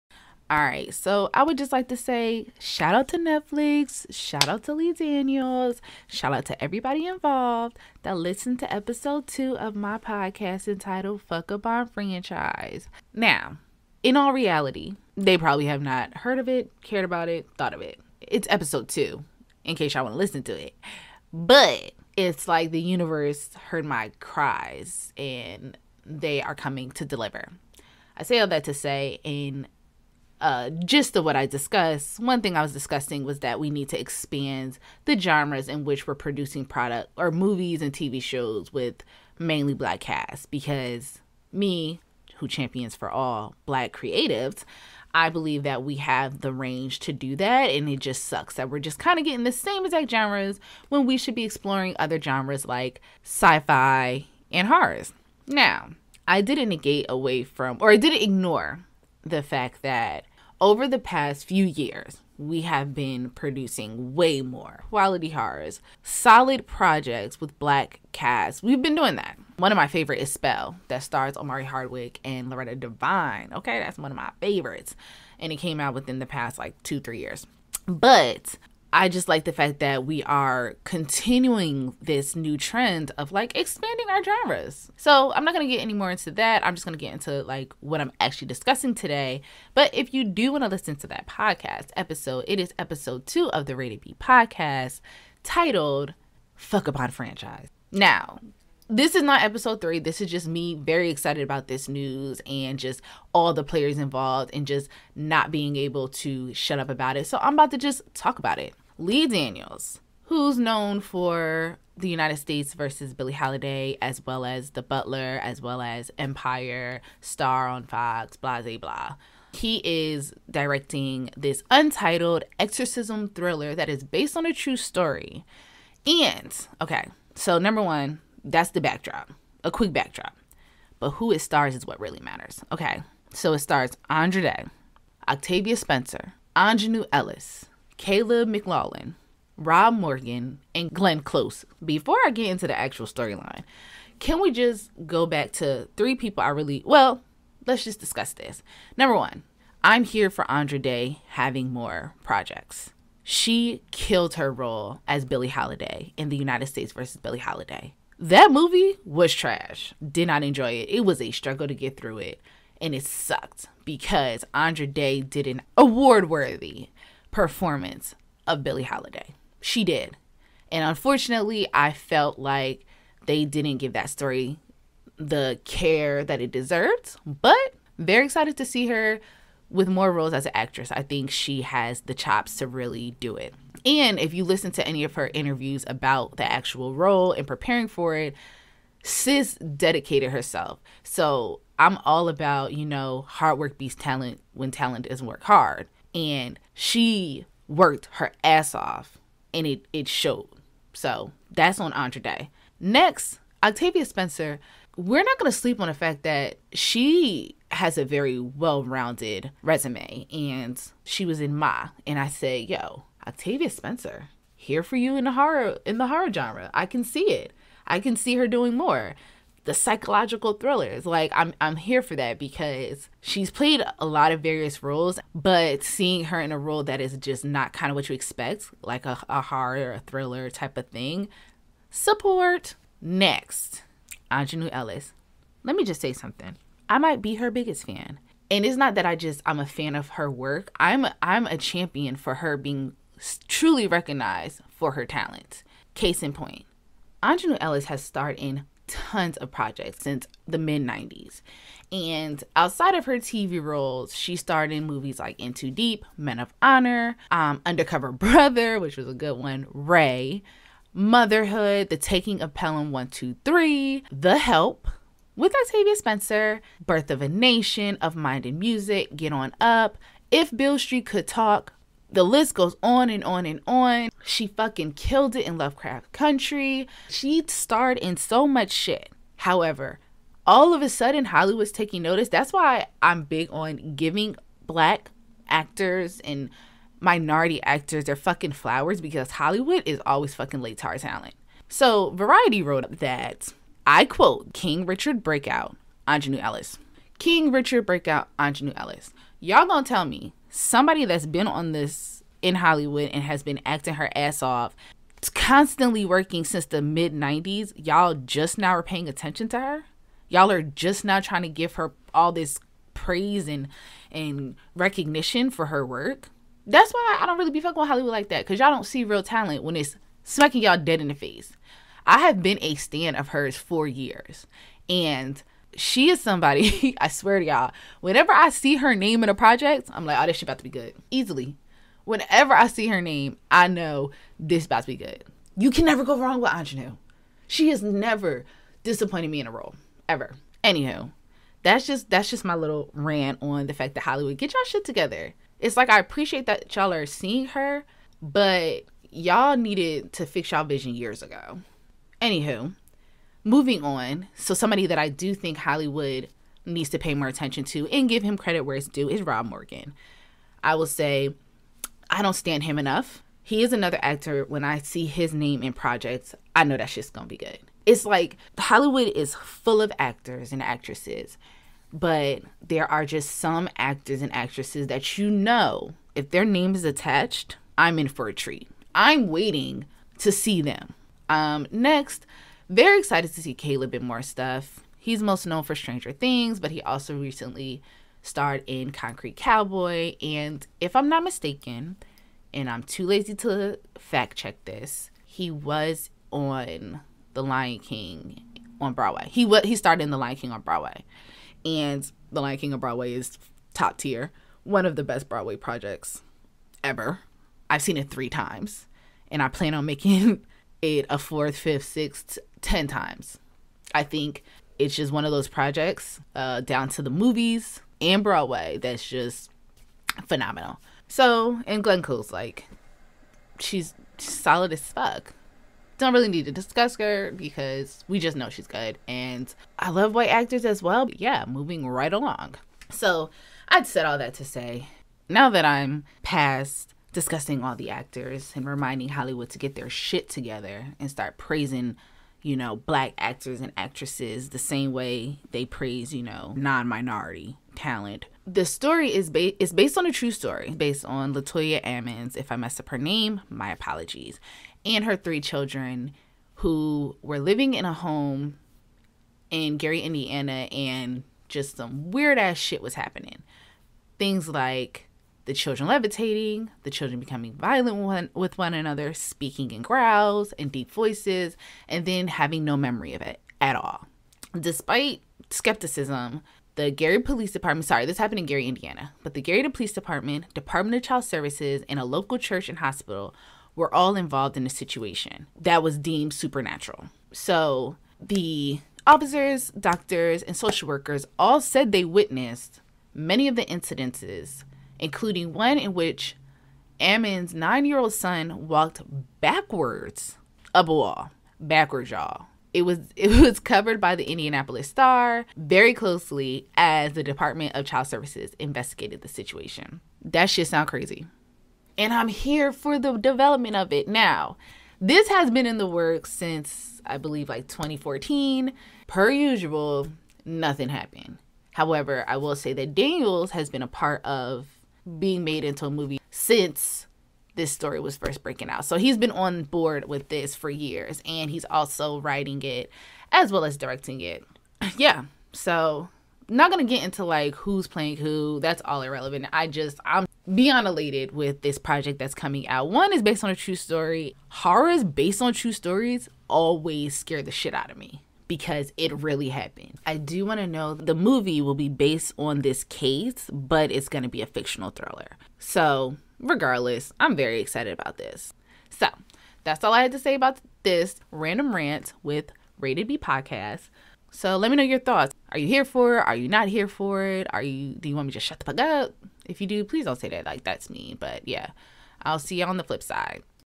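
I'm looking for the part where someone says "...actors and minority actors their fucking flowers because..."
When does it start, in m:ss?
4:45.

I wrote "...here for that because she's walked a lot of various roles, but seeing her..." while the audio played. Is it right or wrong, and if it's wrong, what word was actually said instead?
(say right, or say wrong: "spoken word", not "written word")
wrong: "played", not "walked".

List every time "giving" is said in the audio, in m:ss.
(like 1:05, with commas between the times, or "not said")
4:43.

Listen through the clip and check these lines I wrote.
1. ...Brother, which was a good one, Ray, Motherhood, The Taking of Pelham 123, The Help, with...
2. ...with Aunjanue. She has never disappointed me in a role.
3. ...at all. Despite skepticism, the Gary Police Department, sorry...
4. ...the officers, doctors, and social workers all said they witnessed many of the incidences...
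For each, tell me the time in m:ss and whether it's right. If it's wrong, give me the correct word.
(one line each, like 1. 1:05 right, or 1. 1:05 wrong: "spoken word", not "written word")
1. 4:18 right
2. 5:36 right
3. 7:53 right
4. 8:08 right.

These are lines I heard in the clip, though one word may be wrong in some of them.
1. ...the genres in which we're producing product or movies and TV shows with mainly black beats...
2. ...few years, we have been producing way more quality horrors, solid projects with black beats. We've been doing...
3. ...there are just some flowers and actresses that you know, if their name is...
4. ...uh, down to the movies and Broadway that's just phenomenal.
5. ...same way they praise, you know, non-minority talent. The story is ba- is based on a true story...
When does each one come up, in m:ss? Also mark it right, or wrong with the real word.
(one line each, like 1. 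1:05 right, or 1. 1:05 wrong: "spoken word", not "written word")
1. 0:35 wrong: "casts", not "beats"
2. 1:01 wrong: "casts", not "beats"
3. 6:12 wrong: "actors", not "flowers"
4. 6:56 right
5. 7:24 right.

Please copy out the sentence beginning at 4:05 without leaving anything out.
Case in point, Aunjanue Ellis has starred in tons of projects since the mid 90s.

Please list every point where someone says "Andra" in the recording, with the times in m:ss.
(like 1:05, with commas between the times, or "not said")
2:14, 2:30, 2:44, 3:21.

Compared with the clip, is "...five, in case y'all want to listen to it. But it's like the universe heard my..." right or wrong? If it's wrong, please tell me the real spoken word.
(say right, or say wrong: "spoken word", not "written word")
wrong: "two", not "five".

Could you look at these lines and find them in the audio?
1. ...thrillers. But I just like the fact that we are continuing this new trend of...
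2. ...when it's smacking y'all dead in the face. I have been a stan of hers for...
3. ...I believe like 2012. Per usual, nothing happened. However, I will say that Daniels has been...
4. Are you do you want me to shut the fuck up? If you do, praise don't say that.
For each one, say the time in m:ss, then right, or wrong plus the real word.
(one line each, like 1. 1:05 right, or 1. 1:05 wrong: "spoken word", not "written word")
1. 1:17 wrong: "years", not "thrillers"
2. 5:19 right
3. 8:37 wrong: "2014", not "2012"
4. 9:27 wrong: "please", not "praise".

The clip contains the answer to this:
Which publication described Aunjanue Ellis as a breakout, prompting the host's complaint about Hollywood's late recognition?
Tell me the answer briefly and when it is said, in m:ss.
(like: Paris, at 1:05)
Variety, at 4:52.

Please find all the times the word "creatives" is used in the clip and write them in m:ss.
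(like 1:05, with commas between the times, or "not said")
0:43.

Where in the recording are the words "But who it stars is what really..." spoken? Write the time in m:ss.
2:10.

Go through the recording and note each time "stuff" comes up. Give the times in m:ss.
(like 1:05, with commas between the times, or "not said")
6:24.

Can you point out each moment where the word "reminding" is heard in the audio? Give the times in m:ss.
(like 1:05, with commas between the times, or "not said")
7:18.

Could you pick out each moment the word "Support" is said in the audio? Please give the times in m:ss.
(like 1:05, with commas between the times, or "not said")
3:51.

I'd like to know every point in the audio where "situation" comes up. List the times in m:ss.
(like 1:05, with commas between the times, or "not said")
8:04, 8:29.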